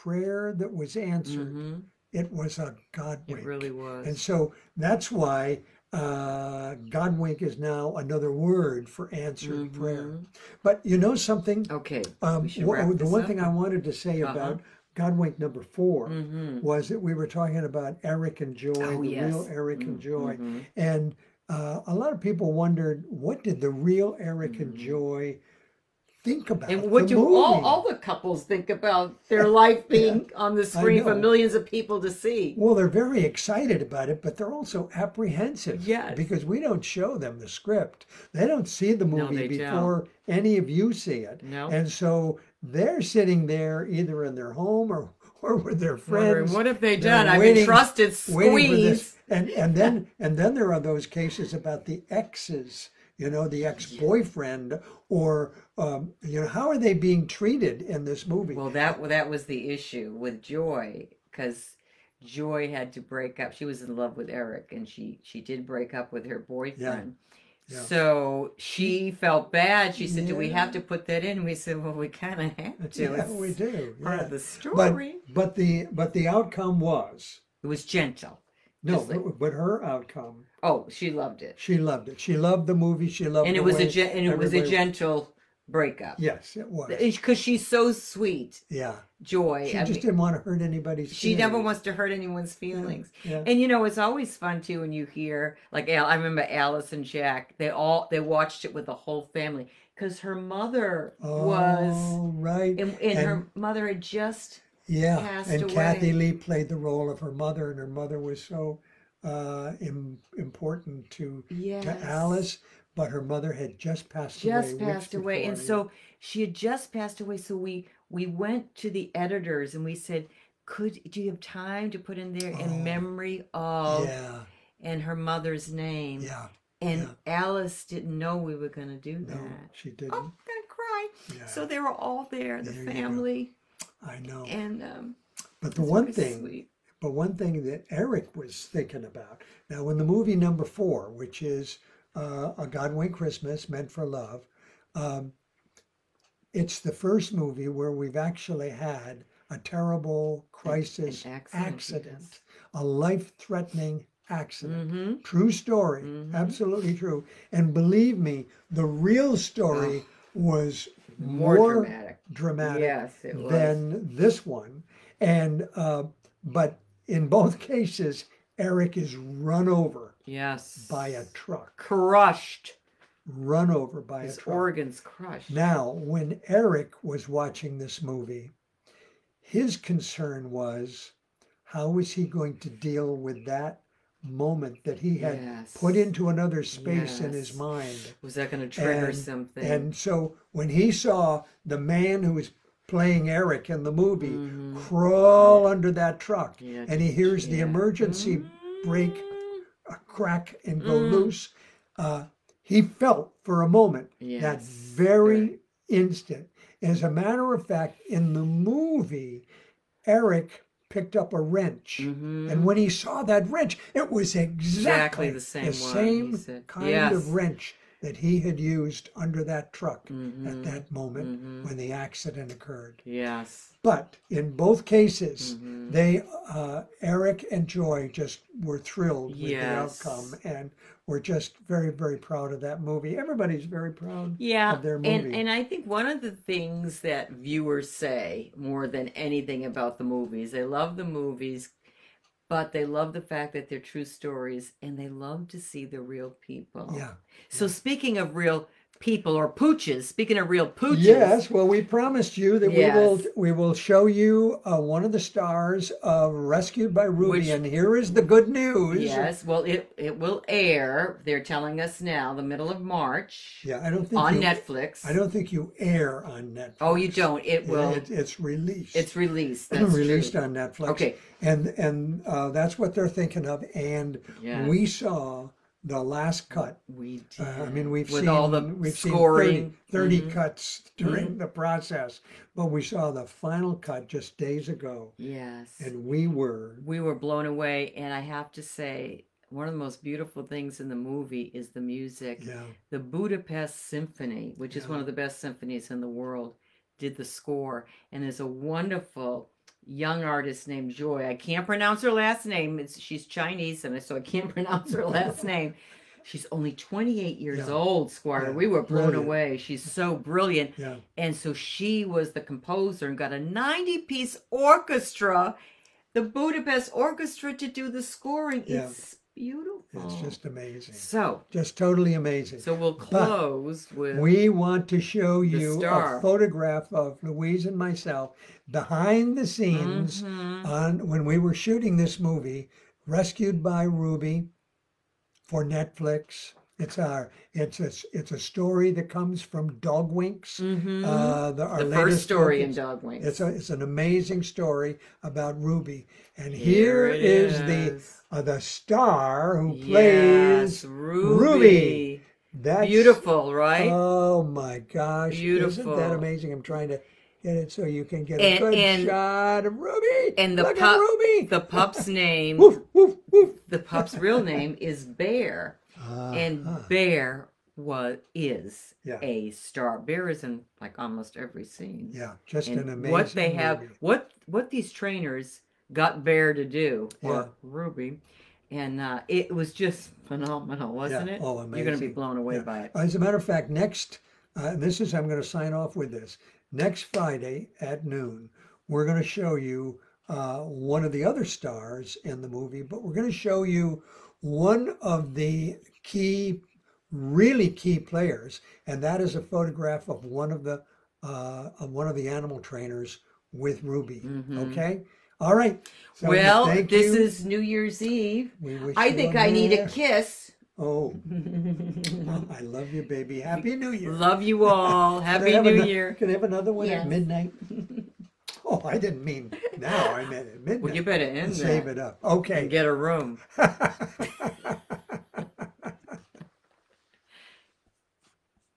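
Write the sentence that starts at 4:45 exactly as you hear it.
Yes, and we were we were blown away.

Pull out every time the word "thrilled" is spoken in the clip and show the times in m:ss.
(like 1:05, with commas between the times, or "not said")
3:48.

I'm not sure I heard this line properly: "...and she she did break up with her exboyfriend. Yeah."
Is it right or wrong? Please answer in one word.
wrong.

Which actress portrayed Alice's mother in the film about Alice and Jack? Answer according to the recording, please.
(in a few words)
Kathie Lee.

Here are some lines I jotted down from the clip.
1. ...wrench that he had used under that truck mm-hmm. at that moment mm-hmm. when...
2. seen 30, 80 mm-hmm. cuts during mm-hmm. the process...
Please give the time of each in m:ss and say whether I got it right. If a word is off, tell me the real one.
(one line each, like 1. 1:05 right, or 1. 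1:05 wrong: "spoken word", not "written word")
1. 3:37 right
2. 4:39 wrong: "30", not "80".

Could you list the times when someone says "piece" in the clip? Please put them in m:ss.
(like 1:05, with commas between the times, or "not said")
5:13.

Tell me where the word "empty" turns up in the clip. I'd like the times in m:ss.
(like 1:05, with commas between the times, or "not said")
not said.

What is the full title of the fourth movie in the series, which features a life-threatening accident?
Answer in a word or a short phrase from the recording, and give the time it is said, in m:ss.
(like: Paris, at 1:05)
A Godwink Christmas, Meant for Love, at 2:22.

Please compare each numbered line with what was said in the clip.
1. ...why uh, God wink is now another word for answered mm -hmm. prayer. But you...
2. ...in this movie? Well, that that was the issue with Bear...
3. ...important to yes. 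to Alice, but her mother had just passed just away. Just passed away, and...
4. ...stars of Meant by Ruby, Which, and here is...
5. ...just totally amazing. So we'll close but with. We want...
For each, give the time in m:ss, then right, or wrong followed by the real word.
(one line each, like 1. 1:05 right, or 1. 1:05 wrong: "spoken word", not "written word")
1. 0:05 right
2. 0:57 wrong: "Joy", not "Bear"
3. 1:50 right
4. 4:15 wrong: "Rescued", not "Meant"
5. 5:21 right.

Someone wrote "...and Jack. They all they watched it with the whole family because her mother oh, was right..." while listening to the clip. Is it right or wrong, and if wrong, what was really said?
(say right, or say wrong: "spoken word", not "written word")
right.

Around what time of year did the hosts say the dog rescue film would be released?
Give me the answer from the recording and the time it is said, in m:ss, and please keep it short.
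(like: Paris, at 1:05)
Middle of March, at 4:22.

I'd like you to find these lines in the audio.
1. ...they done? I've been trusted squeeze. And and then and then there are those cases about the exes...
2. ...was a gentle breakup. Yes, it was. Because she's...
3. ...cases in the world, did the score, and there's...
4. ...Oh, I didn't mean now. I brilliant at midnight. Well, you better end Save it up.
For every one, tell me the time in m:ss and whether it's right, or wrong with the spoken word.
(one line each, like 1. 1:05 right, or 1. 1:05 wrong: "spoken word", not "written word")
1. 0:46 right
2. 1:24 right
3. 4:55 wrong: "symphonies", not "cases"
4. 6:58 wrong: "meant", not "brilliant".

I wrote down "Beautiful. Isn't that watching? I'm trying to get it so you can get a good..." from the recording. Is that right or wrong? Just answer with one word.
wrong.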